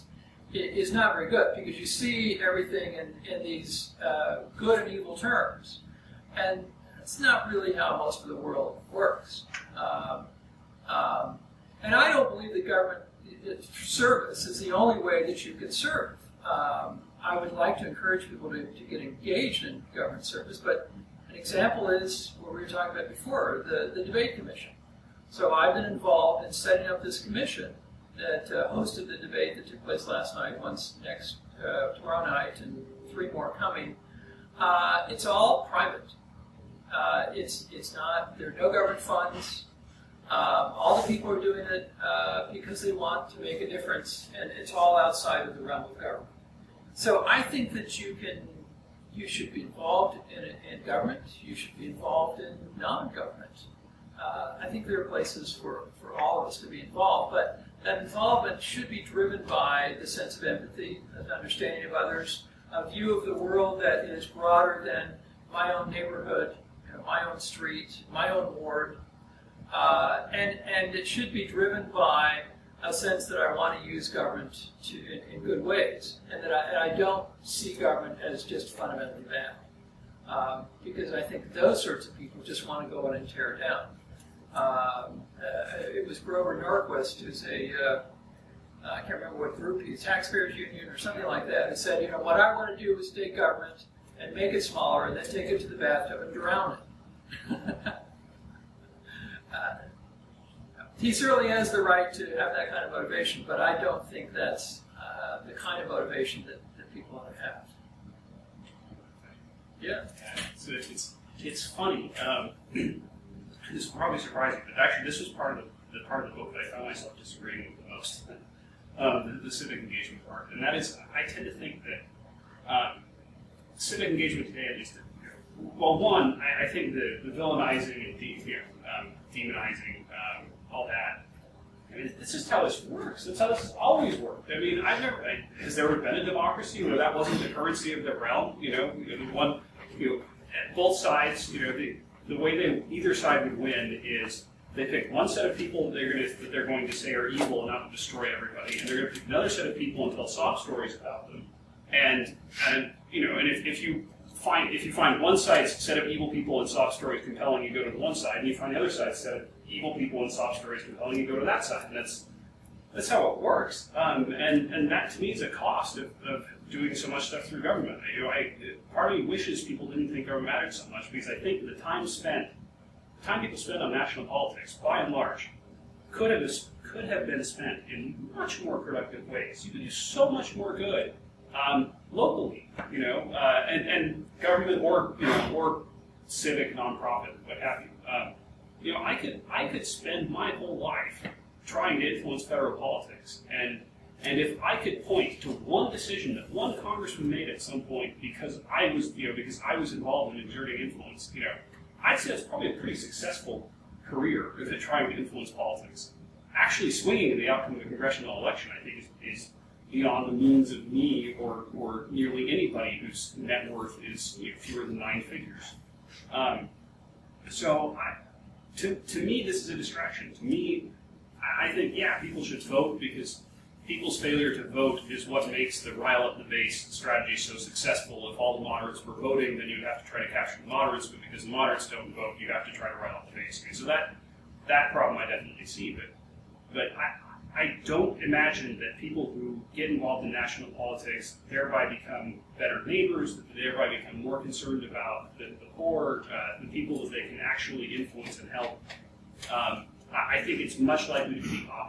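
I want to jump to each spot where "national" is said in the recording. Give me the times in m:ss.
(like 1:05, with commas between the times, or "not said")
2:53, 4:00.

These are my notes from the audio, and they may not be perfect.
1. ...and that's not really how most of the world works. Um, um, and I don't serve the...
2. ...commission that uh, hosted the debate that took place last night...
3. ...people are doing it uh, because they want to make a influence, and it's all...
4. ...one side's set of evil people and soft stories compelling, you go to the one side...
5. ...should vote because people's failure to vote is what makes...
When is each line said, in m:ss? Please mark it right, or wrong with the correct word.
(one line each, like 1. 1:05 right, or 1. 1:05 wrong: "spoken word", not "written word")
1. 0:06 wrong: "believe", not "serve"
2. 0:27 right
3. 0:41 wrong: "difference", not "influence"
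4. 2:35 right
5. 3:42 right.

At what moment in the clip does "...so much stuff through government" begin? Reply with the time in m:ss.
2:46.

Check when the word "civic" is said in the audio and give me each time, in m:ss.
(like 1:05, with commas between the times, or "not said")
1:59, 2:03, 3:06.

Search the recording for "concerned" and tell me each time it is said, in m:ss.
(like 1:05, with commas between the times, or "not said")
4:04.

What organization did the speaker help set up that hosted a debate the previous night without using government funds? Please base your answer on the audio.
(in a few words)
the debate commission.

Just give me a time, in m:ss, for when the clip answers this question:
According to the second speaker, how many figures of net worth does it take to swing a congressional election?
3:34.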